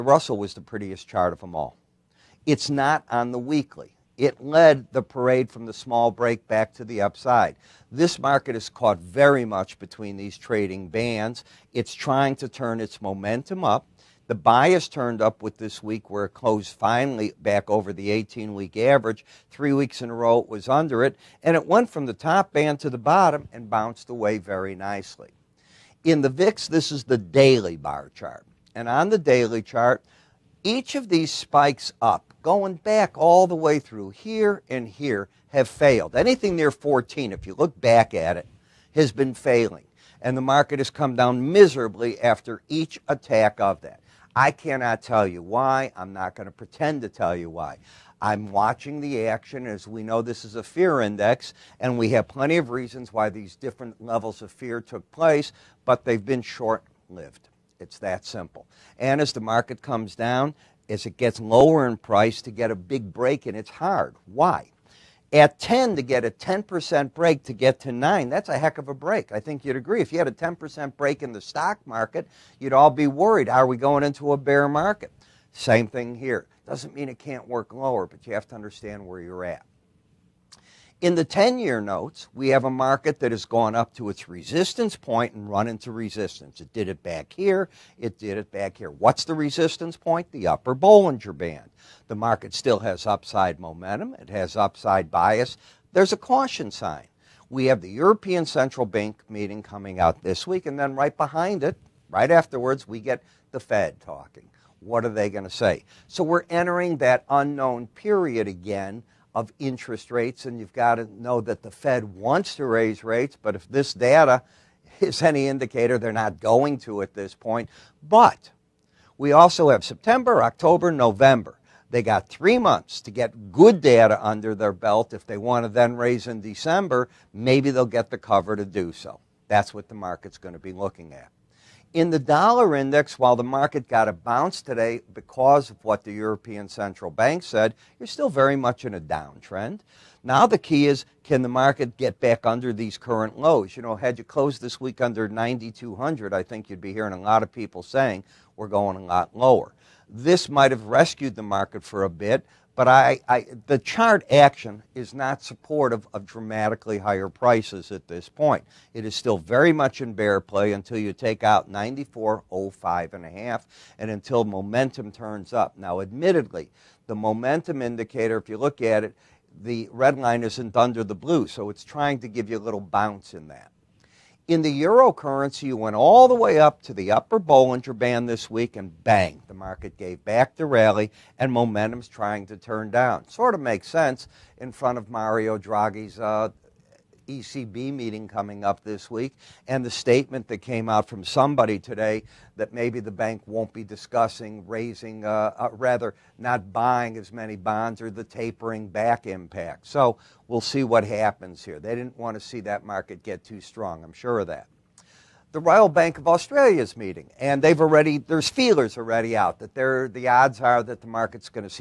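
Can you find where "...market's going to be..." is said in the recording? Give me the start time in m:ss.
2:09.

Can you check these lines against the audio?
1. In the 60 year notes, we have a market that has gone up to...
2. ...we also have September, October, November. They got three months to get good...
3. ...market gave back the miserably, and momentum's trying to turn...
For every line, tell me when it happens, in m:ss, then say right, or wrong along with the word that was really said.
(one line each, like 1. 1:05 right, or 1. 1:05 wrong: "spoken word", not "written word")
1. 1:21 wrong: "10", not "60"
2. 1:59 right
3. 2:59 wrong: "rally", not "miserably".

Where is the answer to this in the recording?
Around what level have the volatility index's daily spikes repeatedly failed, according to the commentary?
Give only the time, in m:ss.
0:36.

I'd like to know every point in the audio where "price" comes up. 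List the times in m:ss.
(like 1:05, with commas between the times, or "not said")
1:01, 2:37.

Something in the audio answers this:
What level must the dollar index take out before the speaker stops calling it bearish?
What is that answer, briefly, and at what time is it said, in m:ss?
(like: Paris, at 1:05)
94.05 and a half, at 2:41.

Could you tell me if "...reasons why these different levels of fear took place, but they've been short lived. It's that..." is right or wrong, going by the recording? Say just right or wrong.
right.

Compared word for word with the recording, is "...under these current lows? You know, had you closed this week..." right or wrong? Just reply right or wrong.
right.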